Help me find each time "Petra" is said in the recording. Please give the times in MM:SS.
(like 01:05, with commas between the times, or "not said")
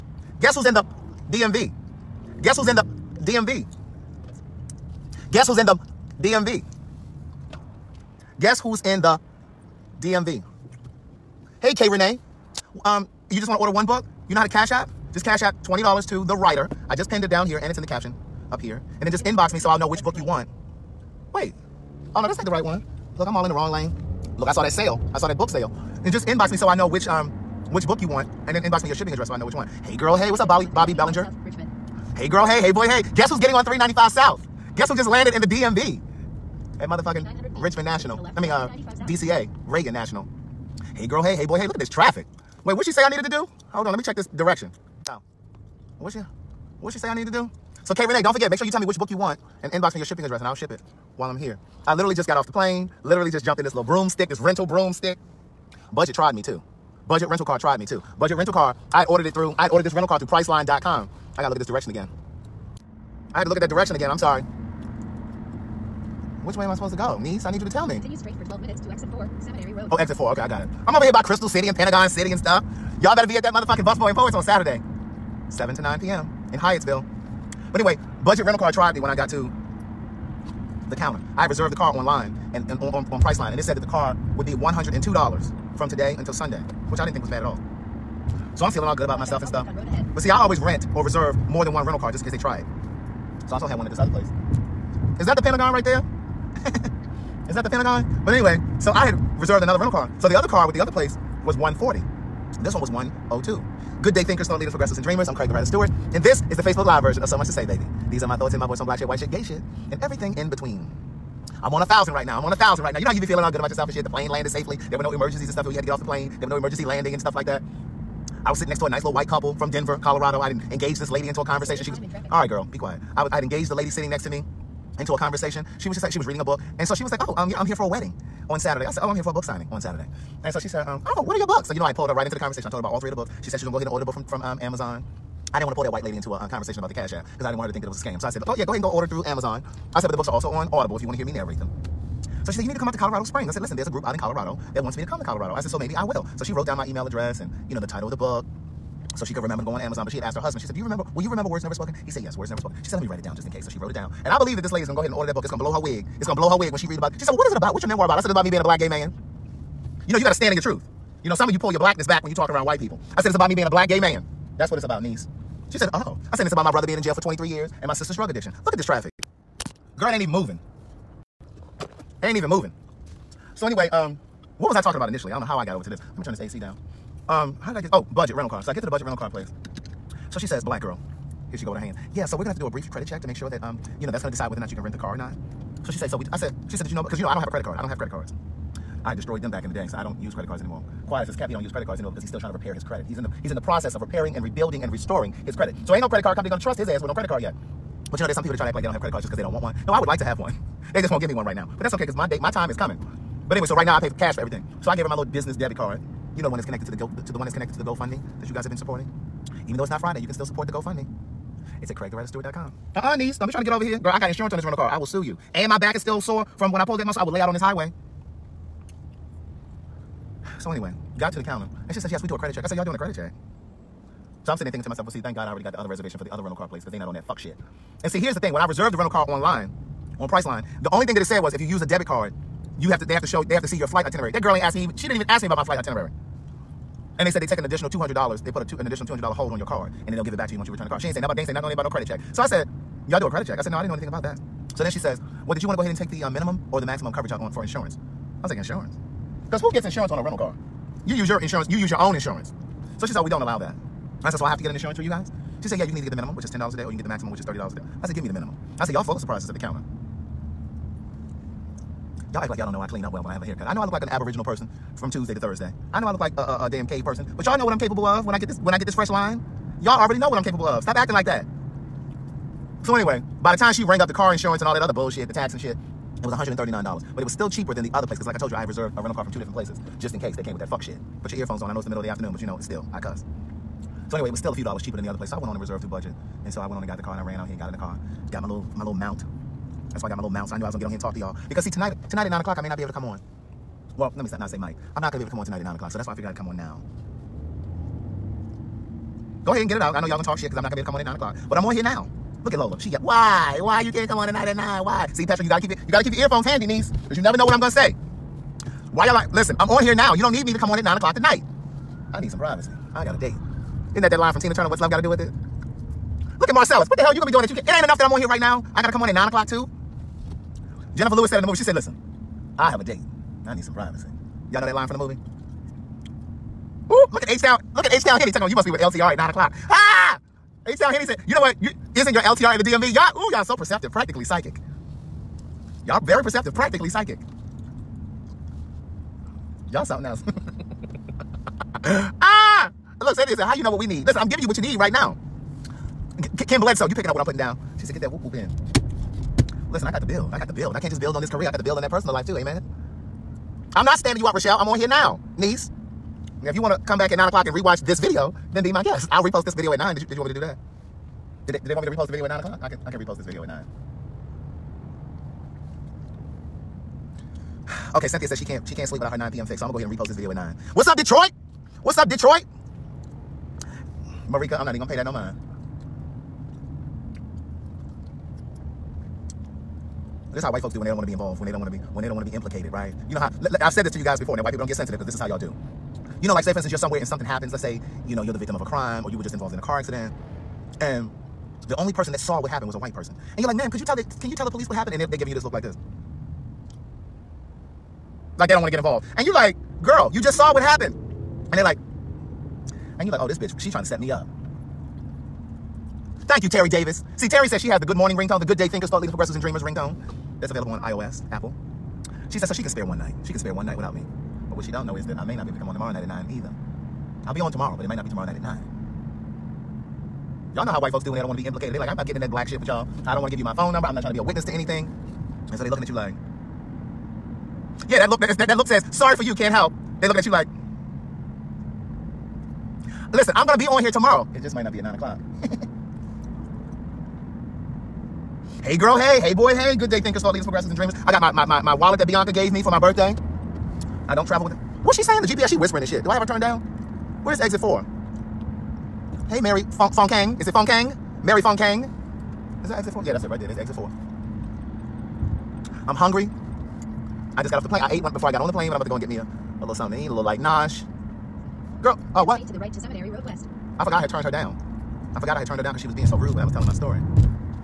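05:05.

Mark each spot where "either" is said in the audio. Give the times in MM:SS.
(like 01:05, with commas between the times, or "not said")
04:15, 06:56.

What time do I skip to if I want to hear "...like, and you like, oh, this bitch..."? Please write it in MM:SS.
06:41.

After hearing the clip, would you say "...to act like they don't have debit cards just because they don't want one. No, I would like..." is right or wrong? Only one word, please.
wrong.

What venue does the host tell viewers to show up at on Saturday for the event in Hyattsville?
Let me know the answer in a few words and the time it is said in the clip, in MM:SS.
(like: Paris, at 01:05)
Busboy and Poets, at 01:13.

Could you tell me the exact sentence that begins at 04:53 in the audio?
Well, let me not, not say might.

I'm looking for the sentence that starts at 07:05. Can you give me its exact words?
And so they looking at you like, yeah, that look that, that, that look says sorry for you, can't help.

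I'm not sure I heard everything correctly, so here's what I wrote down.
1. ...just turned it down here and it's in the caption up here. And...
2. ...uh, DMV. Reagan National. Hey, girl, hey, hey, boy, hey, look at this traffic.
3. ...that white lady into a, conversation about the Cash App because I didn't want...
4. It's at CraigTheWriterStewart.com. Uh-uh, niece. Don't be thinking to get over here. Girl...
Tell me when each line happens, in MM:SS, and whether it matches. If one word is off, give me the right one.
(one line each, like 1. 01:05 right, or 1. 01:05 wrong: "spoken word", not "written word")
1. 00:16 wrong: "pinned", not "turned"
2. 00:38 wrong: "DCA", not "DMV"
3. 02:15 right
4. 03:31 wrong: "trying", not "thinking".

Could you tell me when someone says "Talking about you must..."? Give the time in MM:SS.
05:28.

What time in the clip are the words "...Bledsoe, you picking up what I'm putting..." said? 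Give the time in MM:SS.
05:46.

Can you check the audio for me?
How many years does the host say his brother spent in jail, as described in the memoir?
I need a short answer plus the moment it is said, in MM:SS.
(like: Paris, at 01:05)
23, at 02:47.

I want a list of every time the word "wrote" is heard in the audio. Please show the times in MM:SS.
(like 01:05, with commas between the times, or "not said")
02:26, 02:33.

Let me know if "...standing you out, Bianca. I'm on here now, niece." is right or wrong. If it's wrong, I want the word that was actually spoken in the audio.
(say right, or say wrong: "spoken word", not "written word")
wrong: "Rochelle", not "Bianca".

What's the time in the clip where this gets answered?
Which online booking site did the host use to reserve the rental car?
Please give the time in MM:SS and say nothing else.
01:00.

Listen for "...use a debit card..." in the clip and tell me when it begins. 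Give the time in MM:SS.
03:51.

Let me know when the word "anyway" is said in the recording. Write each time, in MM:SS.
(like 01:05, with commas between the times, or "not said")
01:17, 01:38, 02:53, 03:23, 03:40, 04:32, 04:44.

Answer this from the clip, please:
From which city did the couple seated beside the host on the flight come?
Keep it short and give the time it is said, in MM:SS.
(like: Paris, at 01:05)
Denver, at 01:59.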